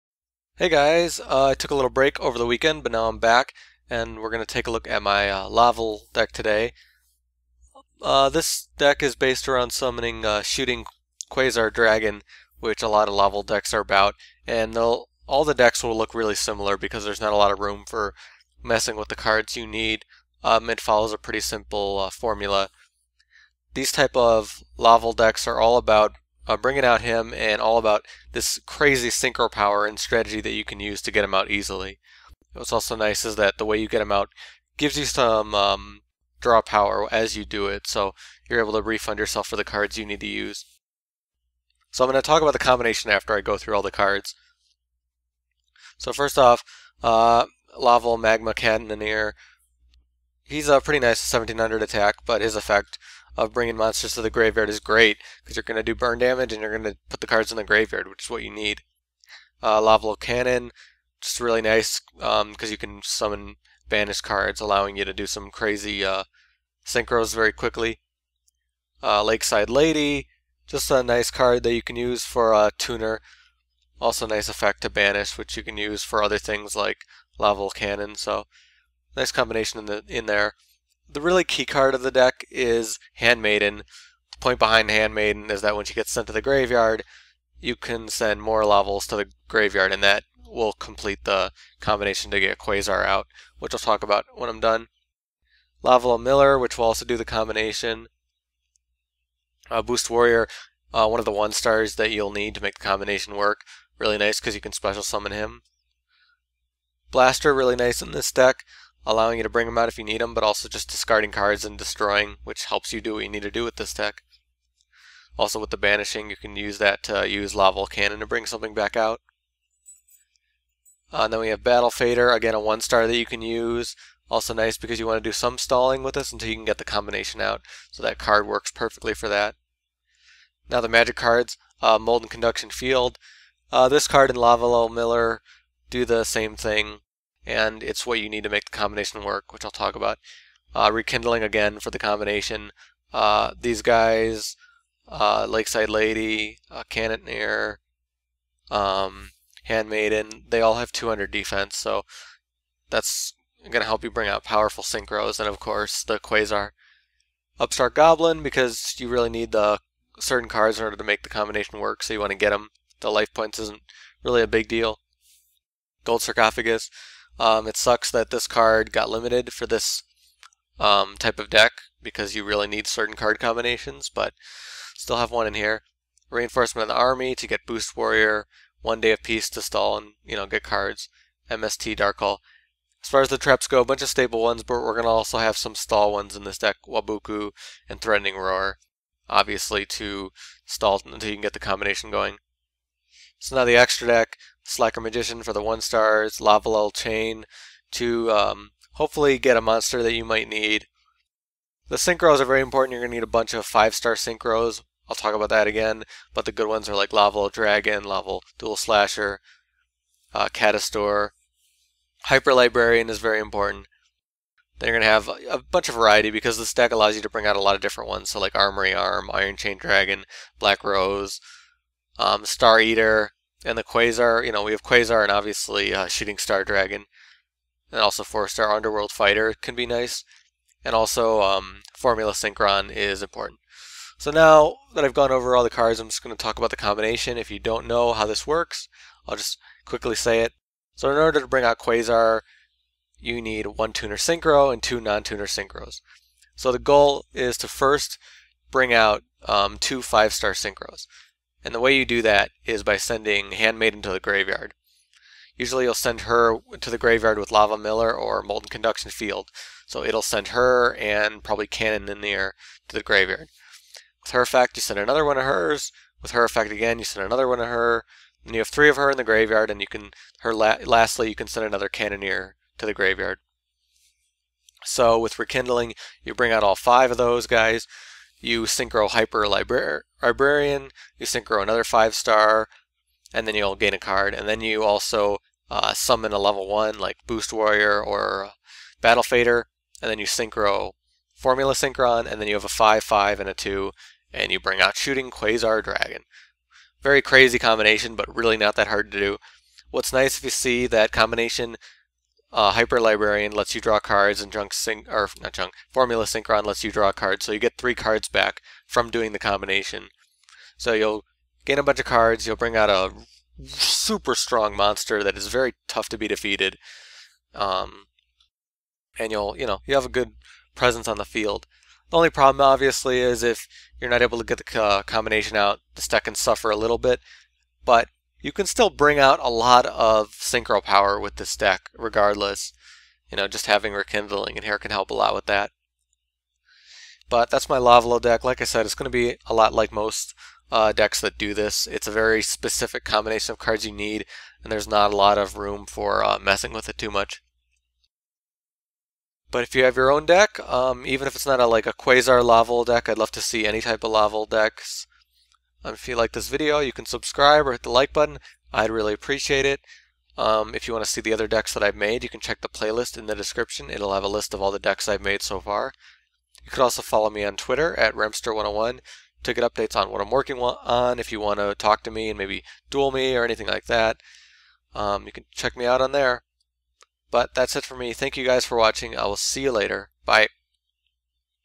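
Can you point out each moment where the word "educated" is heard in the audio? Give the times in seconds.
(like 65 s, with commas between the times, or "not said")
not said.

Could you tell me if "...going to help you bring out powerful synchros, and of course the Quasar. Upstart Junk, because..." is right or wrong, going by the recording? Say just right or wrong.
wrong.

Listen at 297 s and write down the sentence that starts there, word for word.
Very crazy combination, but really not that hard to do.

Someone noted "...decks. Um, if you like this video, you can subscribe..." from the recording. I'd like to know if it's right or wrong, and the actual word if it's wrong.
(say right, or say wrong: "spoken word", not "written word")
right.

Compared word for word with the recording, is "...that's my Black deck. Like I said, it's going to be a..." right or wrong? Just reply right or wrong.
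wrong.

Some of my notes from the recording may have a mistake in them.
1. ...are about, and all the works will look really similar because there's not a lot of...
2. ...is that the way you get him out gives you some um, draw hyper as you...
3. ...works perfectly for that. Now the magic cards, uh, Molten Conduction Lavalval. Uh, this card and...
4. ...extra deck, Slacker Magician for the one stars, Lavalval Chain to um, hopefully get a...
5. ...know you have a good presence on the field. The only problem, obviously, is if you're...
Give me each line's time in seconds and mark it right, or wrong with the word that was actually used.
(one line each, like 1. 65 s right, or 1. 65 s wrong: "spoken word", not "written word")
1. 13 s wrong: "decks", not "works"
2. 33 s wrong: "power", not "hyper"
3. 128 s wrong: "Field", not "Lavalval"
4. 193 s right
5. 319 s right.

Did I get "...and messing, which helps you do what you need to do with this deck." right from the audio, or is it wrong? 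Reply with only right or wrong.
wrong.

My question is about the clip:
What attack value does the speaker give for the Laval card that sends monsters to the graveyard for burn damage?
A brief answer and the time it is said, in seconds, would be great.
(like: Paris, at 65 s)
1700, at 51 s.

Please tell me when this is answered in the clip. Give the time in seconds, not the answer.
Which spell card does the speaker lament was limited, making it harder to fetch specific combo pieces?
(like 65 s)
166 s.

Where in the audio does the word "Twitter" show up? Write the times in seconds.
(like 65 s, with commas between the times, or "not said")
367 s.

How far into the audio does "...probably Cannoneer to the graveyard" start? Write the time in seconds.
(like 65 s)
261 s.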